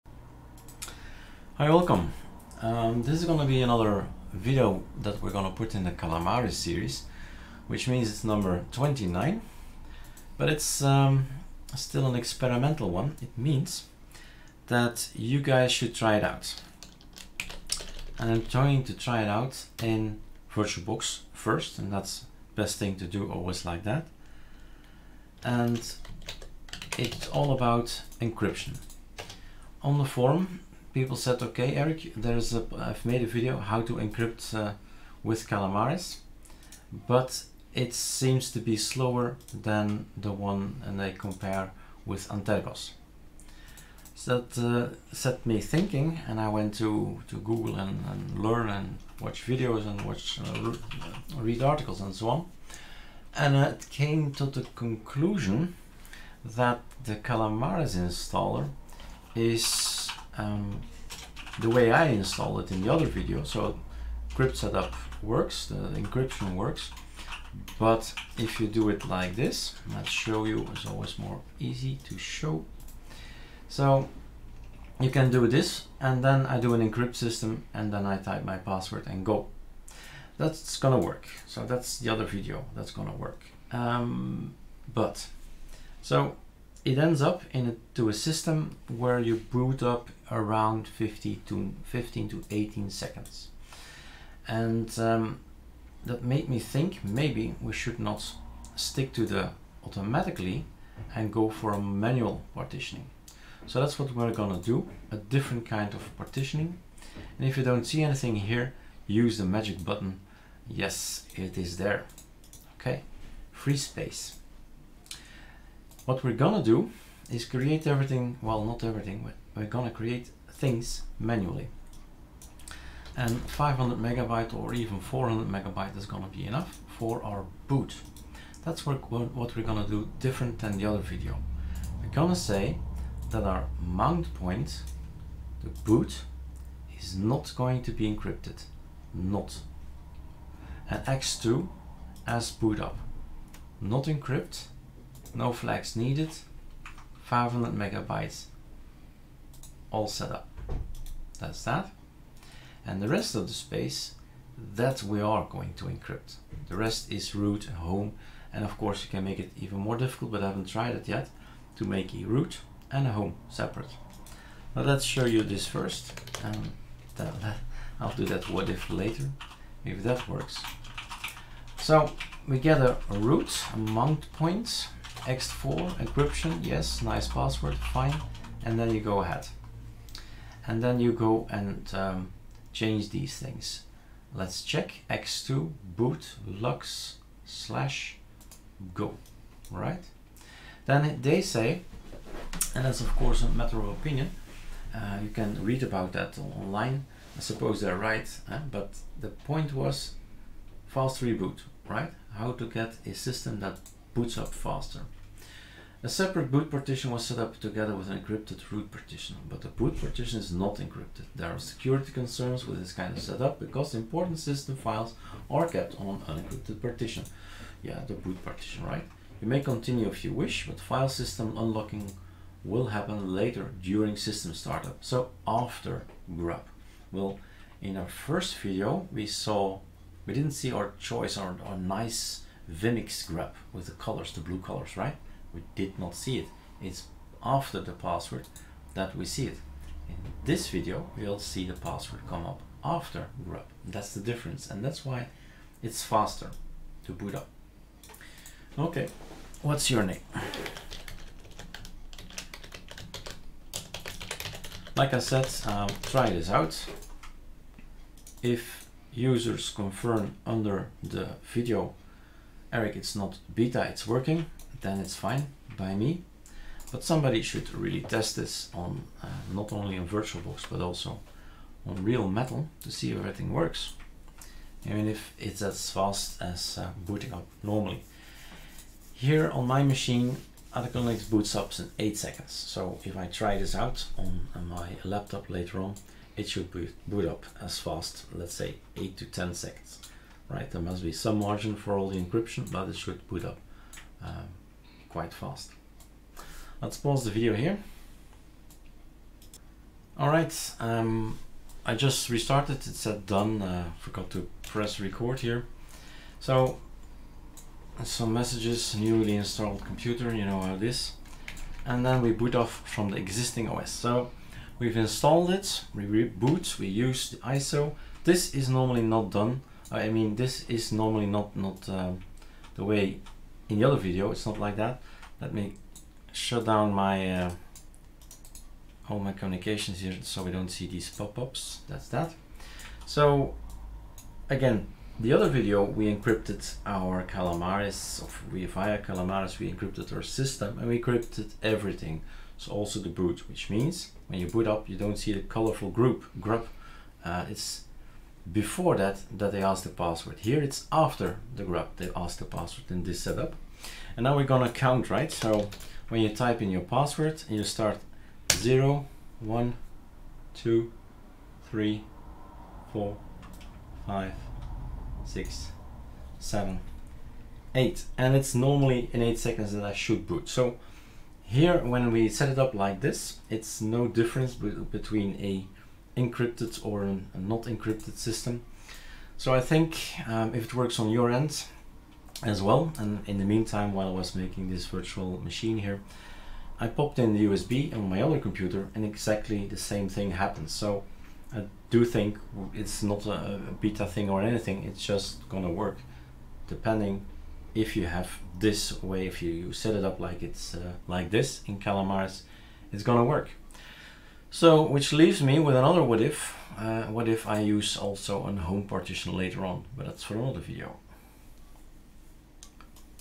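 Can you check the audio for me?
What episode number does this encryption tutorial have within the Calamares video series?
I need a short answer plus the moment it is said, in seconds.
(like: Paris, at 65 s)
29, at 8 s.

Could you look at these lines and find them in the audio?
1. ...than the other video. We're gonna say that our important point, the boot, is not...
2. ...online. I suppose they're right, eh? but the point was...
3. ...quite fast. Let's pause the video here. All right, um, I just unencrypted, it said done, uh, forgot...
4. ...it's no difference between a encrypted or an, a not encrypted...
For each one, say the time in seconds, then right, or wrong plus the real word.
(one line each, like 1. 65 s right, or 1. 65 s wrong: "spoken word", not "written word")
1. 130 s wrong: "mount", not "important"
2. 196 s right
3. 295 s wrong: "restarted", not "unencrypted"
4. 373 s right.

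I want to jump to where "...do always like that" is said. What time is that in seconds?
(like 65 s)
23 s.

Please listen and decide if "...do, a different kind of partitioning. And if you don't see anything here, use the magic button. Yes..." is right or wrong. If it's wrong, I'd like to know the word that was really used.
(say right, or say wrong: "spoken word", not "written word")
right.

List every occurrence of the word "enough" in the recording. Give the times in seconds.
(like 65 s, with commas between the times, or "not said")
126 s.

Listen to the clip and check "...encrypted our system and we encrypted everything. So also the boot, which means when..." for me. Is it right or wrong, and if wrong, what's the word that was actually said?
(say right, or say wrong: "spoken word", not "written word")
right.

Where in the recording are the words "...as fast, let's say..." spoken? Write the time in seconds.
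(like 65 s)
287 s.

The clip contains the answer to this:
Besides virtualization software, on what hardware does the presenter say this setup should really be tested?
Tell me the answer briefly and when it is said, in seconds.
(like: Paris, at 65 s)
real metal, at 272 s.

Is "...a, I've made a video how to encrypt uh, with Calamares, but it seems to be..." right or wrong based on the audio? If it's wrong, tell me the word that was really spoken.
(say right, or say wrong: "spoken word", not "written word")
right.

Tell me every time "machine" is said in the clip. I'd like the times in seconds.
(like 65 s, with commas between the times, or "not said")
279 s, 385 s.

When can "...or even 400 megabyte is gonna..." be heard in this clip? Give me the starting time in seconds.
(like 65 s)
124 s.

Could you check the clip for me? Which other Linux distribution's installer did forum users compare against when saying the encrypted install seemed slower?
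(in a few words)
Antergos.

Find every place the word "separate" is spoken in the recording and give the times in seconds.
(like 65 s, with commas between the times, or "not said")
163 s, 206 s.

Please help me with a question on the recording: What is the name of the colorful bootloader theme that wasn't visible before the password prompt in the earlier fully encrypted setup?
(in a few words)
Vimix.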